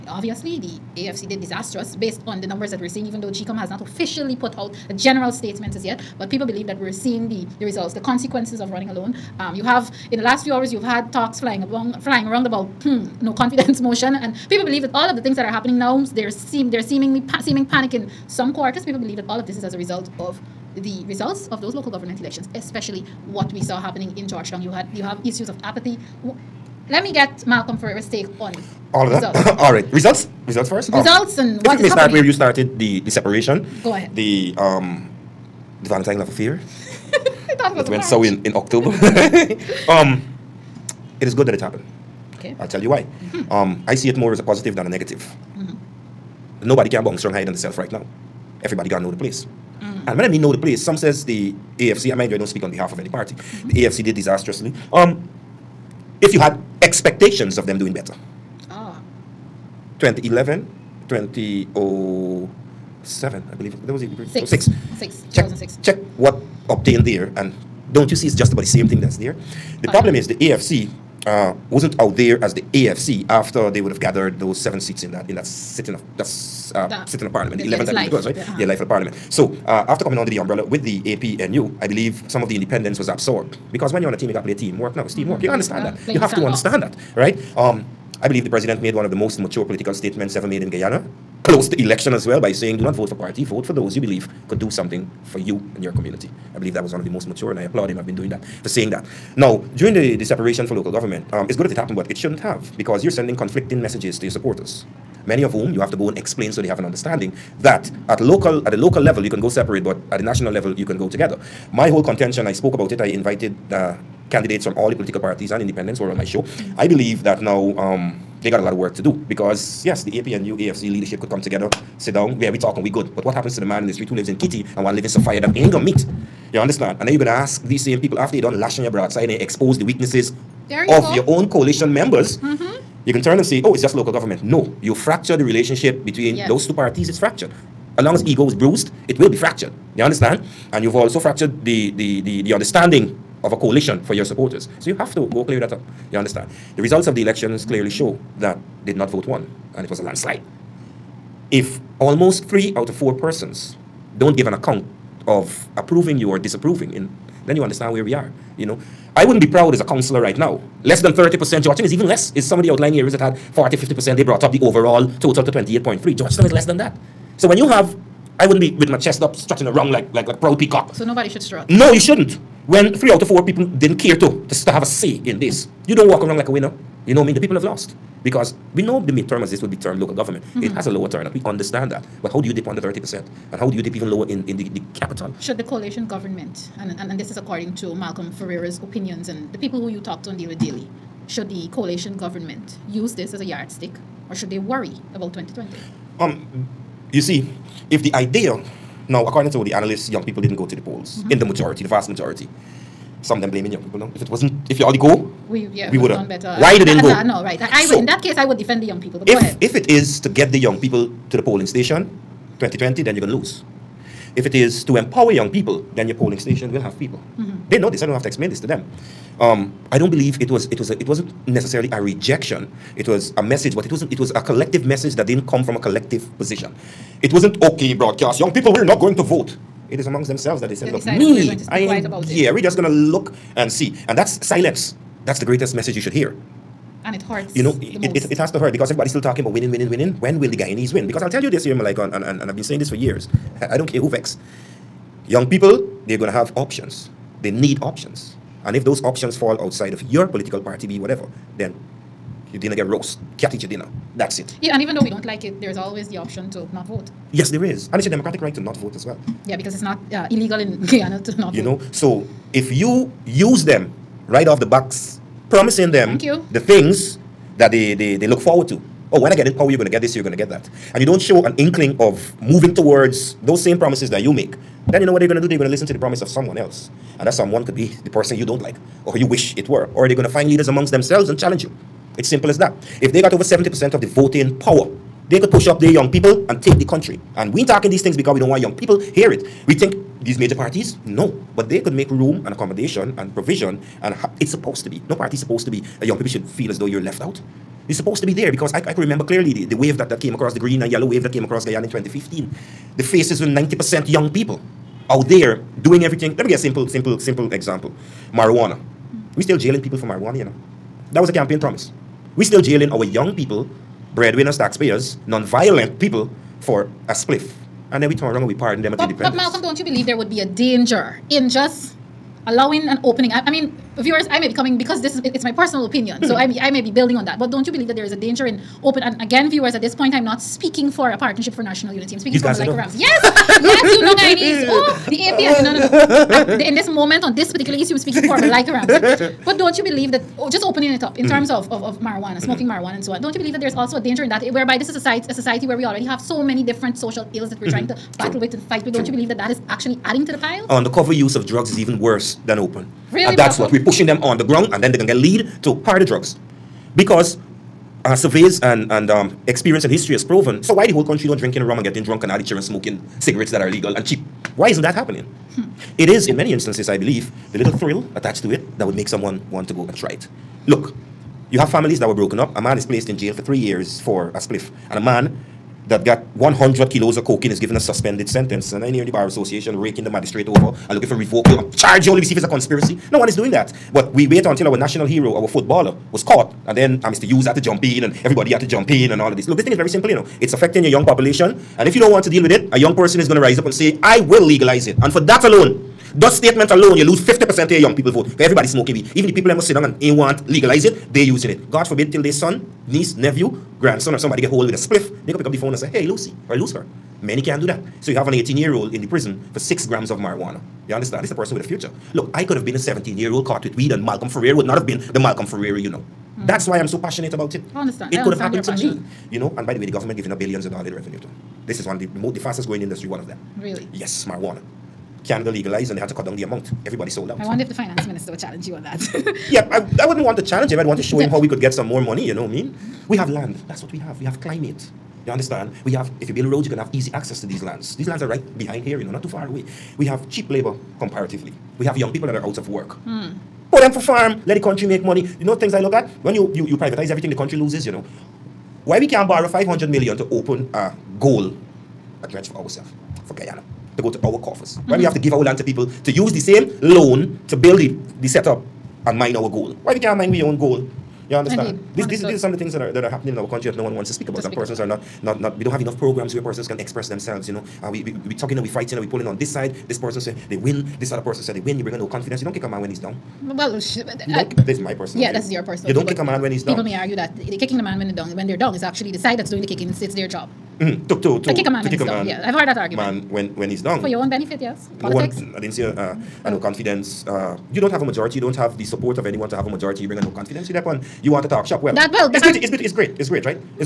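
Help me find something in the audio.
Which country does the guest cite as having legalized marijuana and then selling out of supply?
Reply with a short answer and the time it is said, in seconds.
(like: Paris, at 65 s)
Canada, at 425 s.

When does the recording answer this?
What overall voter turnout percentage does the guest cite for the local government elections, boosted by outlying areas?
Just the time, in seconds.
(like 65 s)
165 s.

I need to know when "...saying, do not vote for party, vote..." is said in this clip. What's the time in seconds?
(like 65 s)
92 s.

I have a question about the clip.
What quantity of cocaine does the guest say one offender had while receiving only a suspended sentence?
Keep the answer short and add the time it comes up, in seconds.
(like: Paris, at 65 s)
100 kilos, at 376 s.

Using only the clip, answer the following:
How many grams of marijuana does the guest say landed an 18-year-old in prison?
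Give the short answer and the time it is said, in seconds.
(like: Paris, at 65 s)
6 grams, at 409 s.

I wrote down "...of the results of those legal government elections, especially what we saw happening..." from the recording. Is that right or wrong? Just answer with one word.
wrong.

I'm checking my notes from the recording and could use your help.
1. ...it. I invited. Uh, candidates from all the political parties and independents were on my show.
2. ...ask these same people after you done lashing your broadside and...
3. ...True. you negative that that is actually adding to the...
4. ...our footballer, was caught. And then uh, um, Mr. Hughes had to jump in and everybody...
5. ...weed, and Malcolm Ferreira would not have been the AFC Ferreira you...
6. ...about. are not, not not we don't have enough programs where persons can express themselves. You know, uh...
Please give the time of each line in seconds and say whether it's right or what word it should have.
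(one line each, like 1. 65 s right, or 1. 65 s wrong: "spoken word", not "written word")
1. 112 s right
2. 127 s right
3. 349 s wrong: "believe", not "negative"
4. 385 s right
5. 413 s wrong: "Malcolm", not "AFC"
6. 464 s right.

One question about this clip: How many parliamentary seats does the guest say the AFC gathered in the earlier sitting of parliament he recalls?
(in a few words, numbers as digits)
7.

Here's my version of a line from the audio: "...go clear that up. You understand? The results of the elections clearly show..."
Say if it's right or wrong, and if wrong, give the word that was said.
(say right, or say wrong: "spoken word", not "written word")
right.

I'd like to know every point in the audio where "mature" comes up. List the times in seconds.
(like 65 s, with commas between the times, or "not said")
89 s, 97 s.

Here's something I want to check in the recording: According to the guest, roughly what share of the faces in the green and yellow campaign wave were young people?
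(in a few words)
90%.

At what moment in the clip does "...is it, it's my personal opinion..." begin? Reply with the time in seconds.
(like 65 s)
325 s.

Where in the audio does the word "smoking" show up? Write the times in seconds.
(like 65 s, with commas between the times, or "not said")
342 s, 362 s, 398 s.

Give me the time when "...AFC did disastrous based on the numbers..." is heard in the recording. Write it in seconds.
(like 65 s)
0 s.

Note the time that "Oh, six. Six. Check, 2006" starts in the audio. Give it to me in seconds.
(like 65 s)
64 s.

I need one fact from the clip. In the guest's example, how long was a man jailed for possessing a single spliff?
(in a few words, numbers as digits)
3 years.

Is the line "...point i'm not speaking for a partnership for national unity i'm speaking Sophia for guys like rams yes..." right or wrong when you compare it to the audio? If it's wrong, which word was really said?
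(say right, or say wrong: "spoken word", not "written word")
wrong: "These", not "Sophia".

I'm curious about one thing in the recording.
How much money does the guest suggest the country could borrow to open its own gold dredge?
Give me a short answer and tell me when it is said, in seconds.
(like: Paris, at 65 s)
500 million, at 449 s.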